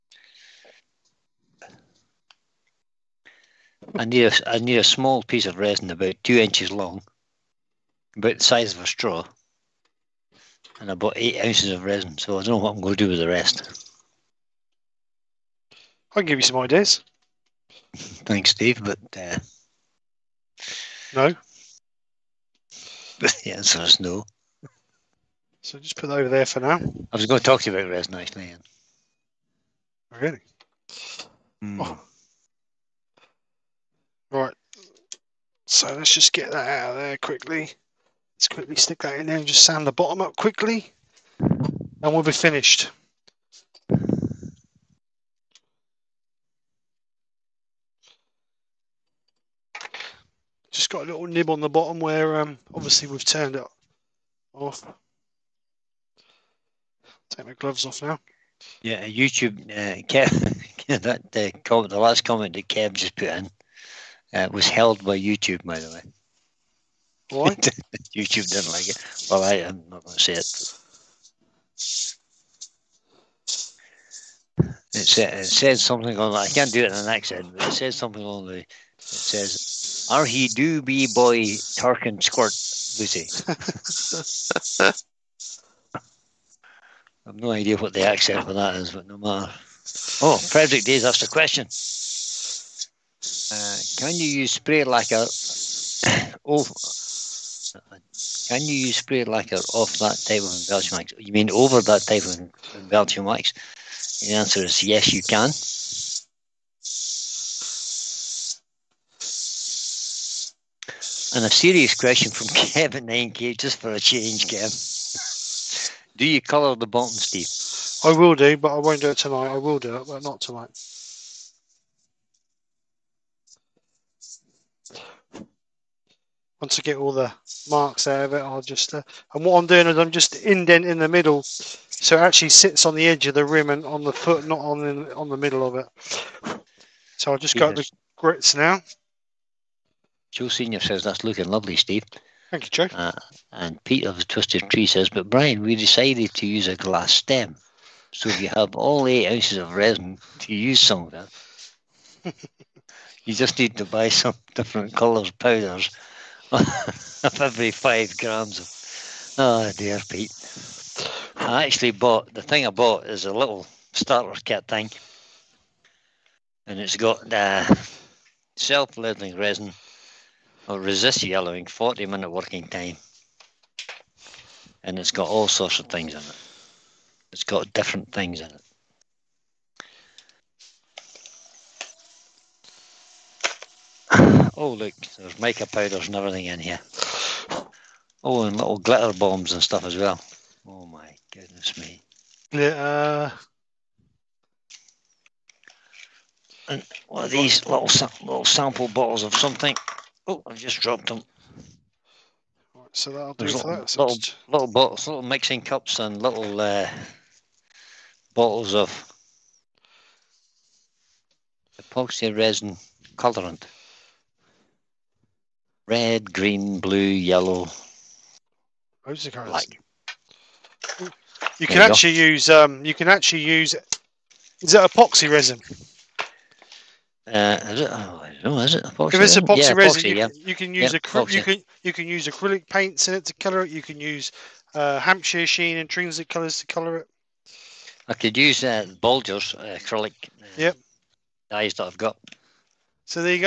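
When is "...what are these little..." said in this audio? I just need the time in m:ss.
3:17.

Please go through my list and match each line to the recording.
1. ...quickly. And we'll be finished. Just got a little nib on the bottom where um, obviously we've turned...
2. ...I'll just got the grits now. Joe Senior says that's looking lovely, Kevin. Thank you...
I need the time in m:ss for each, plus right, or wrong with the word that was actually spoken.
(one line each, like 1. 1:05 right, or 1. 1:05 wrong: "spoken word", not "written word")
1. 0:40 right
2. 2:17 wrong: "Steve", not "Kevin".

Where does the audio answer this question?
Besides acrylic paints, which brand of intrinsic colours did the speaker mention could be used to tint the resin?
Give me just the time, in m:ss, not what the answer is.
3:54.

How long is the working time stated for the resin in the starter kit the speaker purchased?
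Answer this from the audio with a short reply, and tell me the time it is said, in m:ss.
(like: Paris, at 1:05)
40 minutes, at 2:51.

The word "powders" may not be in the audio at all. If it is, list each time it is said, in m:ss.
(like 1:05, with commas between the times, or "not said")
2:35, 3:05.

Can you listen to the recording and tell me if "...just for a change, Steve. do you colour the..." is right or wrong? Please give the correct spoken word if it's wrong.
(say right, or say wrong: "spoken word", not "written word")
wrong: "Kevin", not "Steve".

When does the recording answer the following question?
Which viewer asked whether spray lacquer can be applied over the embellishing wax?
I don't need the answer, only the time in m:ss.
1:30.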